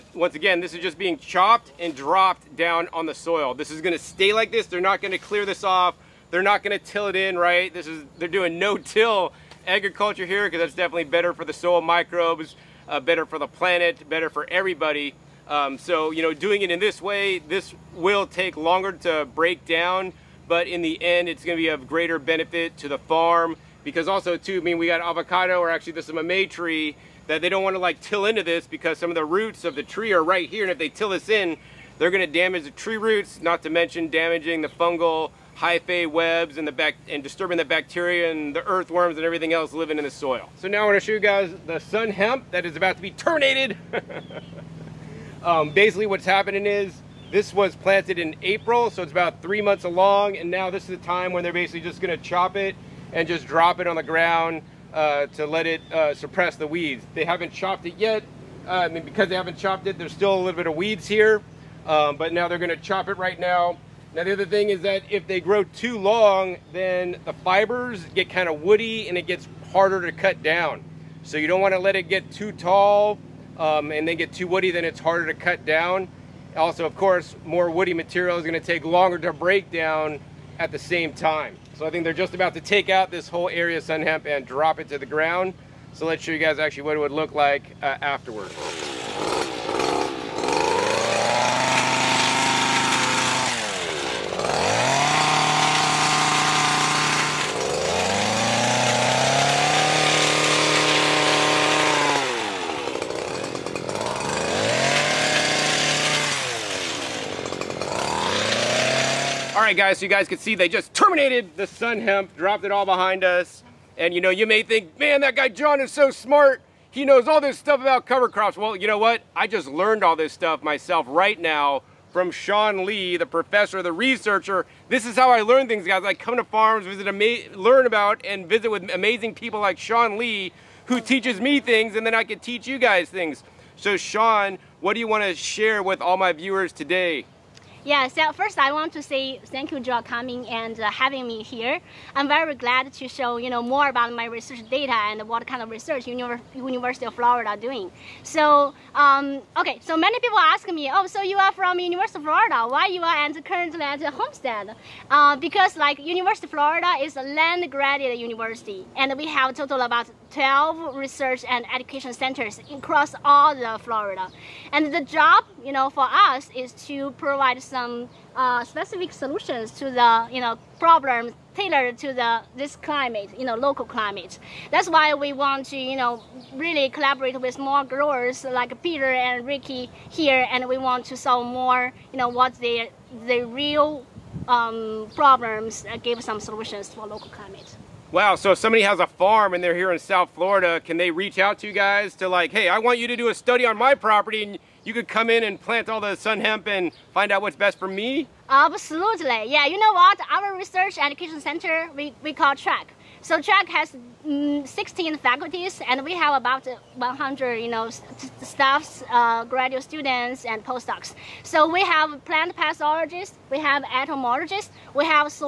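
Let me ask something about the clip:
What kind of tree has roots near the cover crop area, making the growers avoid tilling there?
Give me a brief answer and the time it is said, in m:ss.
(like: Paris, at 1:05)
May tree, at 0:26.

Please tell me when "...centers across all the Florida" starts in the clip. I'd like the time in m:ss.
2:42.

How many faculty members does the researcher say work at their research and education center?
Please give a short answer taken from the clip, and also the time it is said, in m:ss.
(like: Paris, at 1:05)
16, at 3:24.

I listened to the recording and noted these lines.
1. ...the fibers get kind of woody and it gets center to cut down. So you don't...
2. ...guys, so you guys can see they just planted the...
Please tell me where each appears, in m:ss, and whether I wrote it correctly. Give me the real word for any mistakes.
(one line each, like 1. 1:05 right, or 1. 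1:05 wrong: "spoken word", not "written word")
1. 1:07 wrong: "harder", not "center"
2. 1:49 wrong: "terminated", not "planted".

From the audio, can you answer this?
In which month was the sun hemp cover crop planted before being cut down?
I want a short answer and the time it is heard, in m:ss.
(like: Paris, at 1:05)
April, at 0:48.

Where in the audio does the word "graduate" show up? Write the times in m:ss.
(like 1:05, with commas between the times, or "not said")
2:37, 3:29.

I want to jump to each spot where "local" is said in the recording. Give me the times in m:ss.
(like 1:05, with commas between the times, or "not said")
2:53, 3:07.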